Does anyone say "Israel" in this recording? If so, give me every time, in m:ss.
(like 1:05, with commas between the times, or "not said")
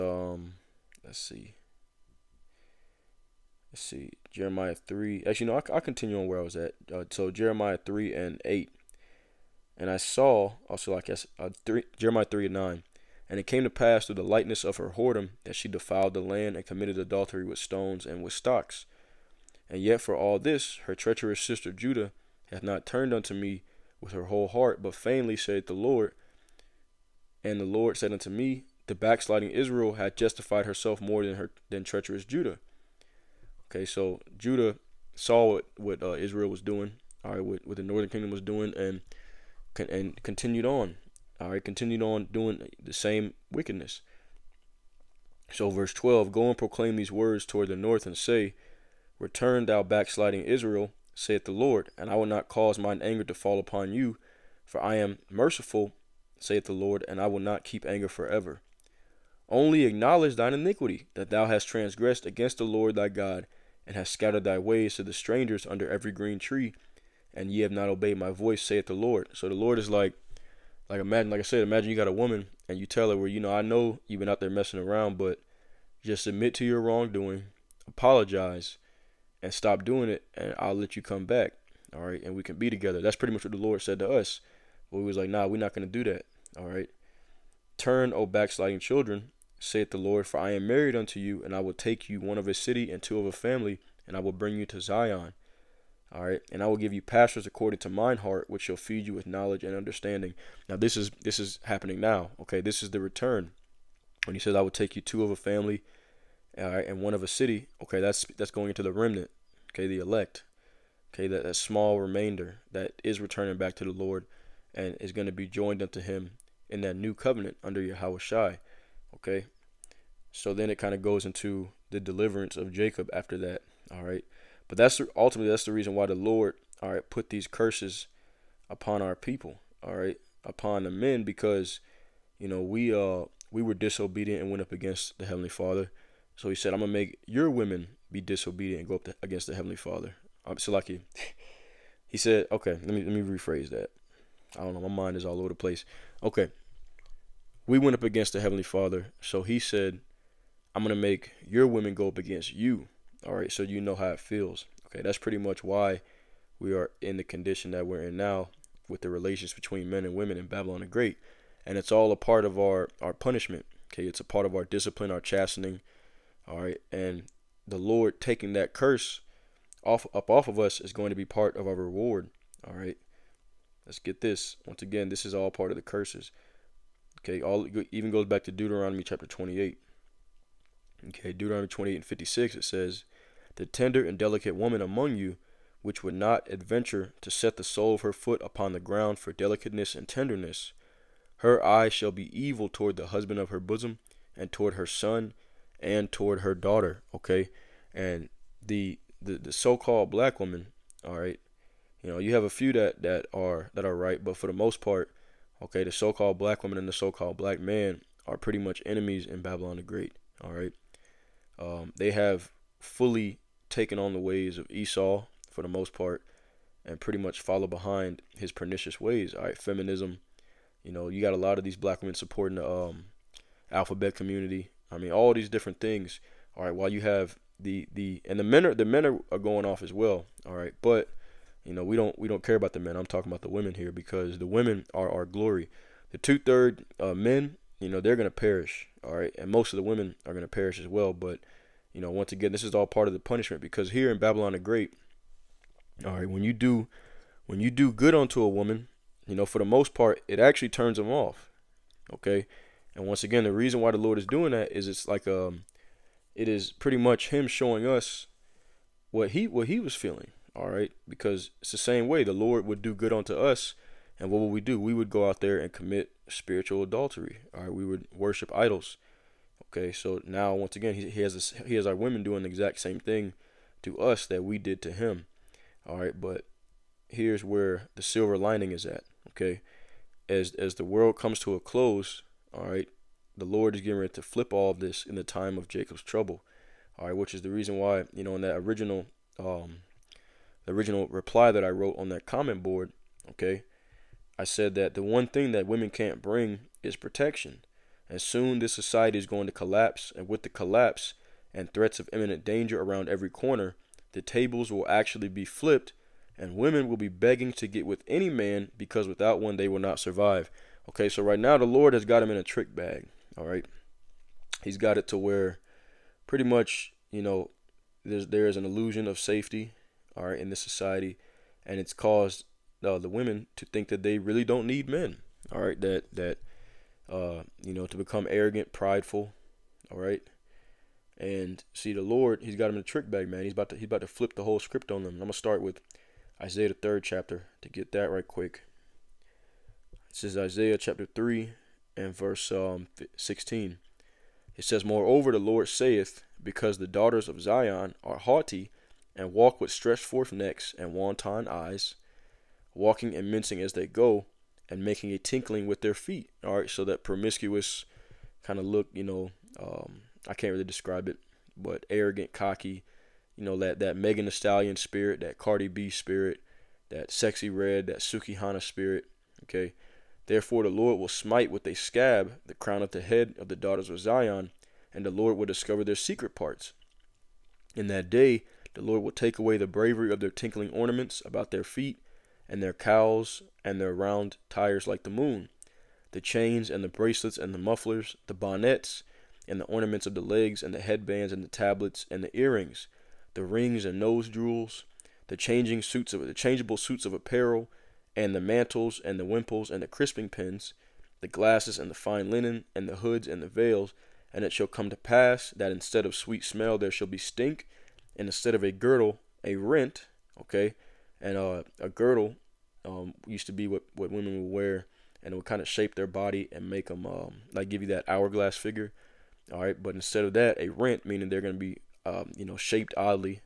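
0:29, 0:36, 0:50.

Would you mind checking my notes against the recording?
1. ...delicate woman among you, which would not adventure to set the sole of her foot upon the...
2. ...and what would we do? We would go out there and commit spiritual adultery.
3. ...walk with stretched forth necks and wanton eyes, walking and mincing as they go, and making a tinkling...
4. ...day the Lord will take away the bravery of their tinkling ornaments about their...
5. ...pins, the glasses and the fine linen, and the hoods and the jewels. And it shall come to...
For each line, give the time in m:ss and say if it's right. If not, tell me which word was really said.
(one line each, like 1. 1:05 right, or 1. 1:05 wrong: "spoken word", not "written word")
1. 3:04 right
2. 4:24 right
3. 5:49 right
4. 6:18 right
5. 6:40 wrong: "veils", not "jewels".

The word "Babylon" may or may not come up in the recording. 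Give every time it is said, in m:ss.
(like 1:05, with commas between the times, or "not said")
2:40, 3:29, 4:04.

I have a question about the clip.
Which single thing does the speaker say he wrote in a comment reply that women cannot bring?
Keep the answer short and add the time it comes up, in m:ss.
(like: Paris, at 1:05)
Protection, at 4:56.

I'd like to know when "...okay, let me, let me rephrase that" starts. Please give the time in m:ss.
2:22.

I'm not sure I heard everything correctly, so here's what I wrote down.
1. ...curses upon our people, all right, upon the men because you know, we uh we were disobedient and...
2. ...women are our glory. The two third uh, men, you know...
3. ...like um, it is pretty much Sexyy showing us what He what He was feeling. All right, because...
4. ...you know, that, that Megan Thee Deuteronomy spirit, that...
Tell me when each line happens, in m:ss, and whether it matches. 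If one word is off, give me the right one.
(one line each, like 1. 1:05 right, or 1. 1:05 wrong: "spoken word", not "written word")
1. 2:07 right
2. 3:54 right
3. 4:15 wrong: "Him", not "Sexyy"
4. 6:03 wrong: "Stallion", not "Deuteronomy".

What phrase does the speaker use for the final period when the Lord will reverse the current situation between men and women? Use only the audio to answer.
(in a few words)
Jacob's trouble.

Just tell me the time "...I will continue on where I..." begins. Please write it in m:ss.
0:05.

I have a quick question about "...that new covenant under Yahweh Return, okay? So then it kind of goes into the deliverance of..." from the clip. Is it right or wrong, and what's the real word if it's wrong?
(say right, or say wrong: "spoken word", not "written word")
wrong: "Shai", not "Return".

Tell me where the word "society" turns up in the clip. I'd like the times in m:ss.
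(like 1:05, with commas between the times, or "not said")
4:58, 5:20.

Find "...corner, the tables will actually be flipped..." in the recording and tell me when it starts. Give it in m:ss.
5:03.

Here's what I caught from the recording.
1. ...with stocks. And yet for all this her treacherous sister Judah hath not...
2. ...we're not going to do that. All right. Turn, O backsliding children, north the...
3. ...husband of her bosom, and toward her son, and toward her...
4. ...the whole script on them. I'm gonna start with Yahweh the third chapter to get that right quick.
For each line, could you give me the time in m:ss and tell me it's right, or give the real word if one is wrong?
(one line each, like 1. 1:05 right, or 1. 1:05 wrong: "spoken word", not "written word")
1. 0:18 right
2. 1:25 wrong: "saith", not "north"
3. 3:13 right
4. 5:34 wrong: "Isaiah", not "Yahweh".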